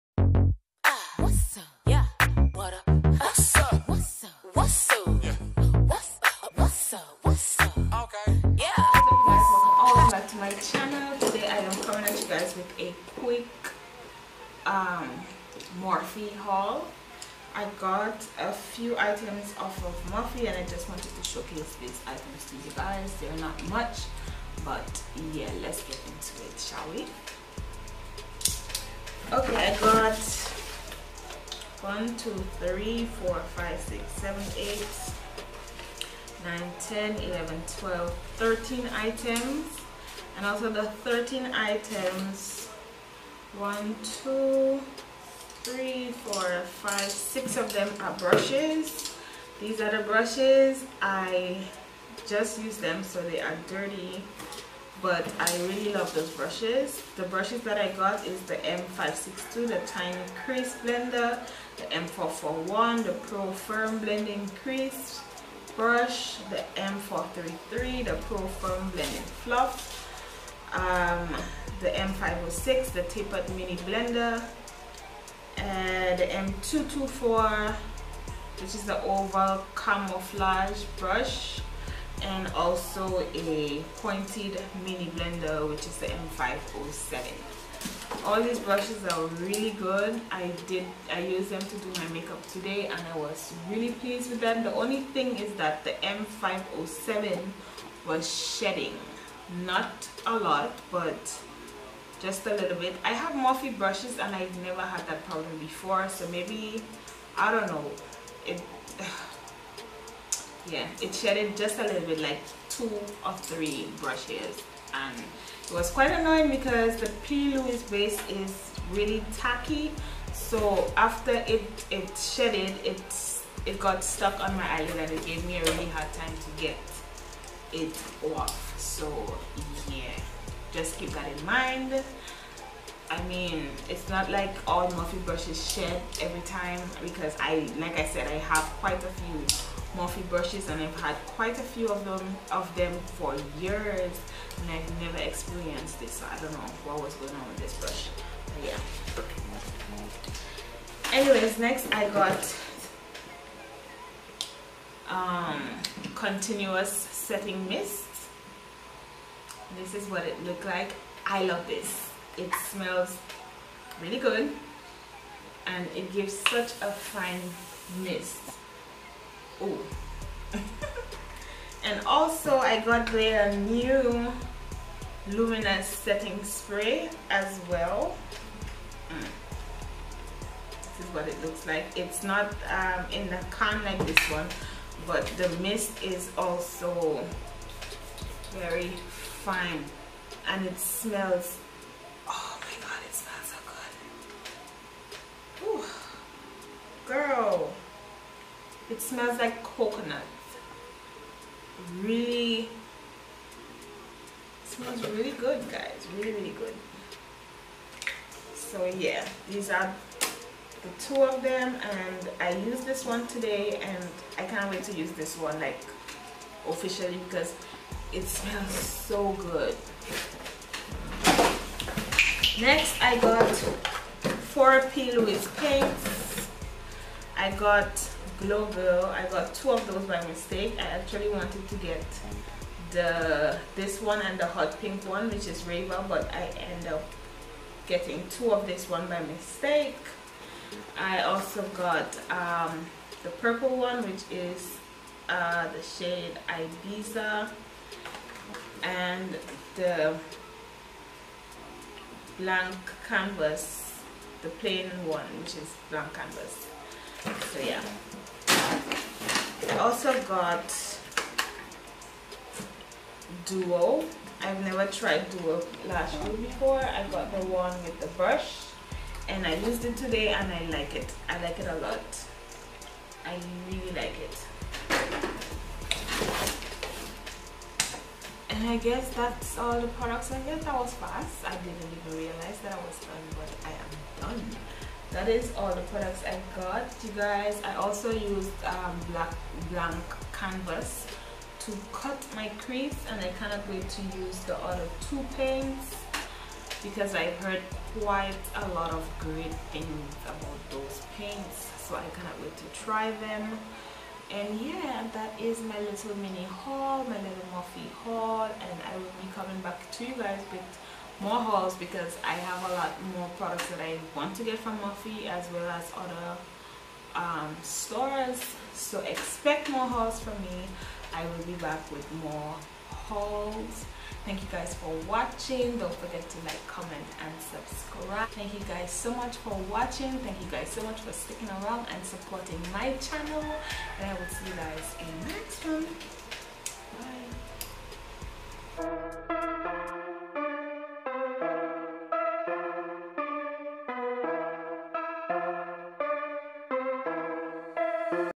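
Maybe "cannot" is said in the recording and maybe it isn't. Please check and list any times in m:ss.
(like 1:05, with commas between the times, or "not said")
4:53, 5:02.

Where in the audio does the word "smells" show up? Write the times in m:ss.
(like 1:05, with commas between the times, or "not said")
2:42, 3:10, 3:19, 3:24, 3:38.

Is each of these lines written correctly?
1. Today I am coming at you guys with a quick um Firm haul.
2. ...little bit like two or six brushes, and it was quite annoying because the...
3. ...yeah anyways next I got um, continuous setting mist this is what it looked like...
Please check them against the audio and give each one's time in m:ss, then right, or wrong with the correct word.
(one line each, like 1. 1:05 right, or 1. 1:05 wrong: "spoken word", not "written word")
1. 0:11 wrong: "Morphe", not "Firm"
2. 1:51 wrong: "three", not "six"
3. 2:31 right.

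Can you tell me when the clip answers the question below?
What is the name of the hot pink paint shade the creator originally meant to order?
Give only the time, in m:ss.
3:55.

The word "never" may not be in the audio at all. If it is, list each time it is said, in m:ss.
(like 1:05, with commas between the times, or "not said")
1:44, 2:25, 4:24.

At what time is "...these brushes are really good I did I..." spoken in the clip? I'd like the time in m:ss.
1:28.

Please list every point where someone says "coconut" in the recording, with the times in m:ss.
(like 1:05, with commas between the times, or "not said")
3:19.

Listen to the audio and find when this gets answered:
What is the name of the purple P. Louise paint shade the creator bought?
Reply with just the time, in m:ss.
4:06.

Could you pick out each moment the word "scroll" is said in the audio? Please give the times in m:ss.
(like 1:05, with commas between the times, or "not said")
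not said.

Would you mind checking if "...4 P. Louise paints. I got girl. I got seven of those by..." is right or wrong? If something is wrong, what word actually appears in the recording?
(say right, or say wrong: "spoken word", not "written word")
wrong: "two", not "seven".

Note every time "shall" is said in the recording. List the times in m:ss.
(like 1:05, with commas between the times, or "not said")
0:26.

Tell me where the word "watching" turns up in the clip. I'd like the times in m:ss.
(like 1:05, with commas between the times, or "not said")
5:25, 5:29.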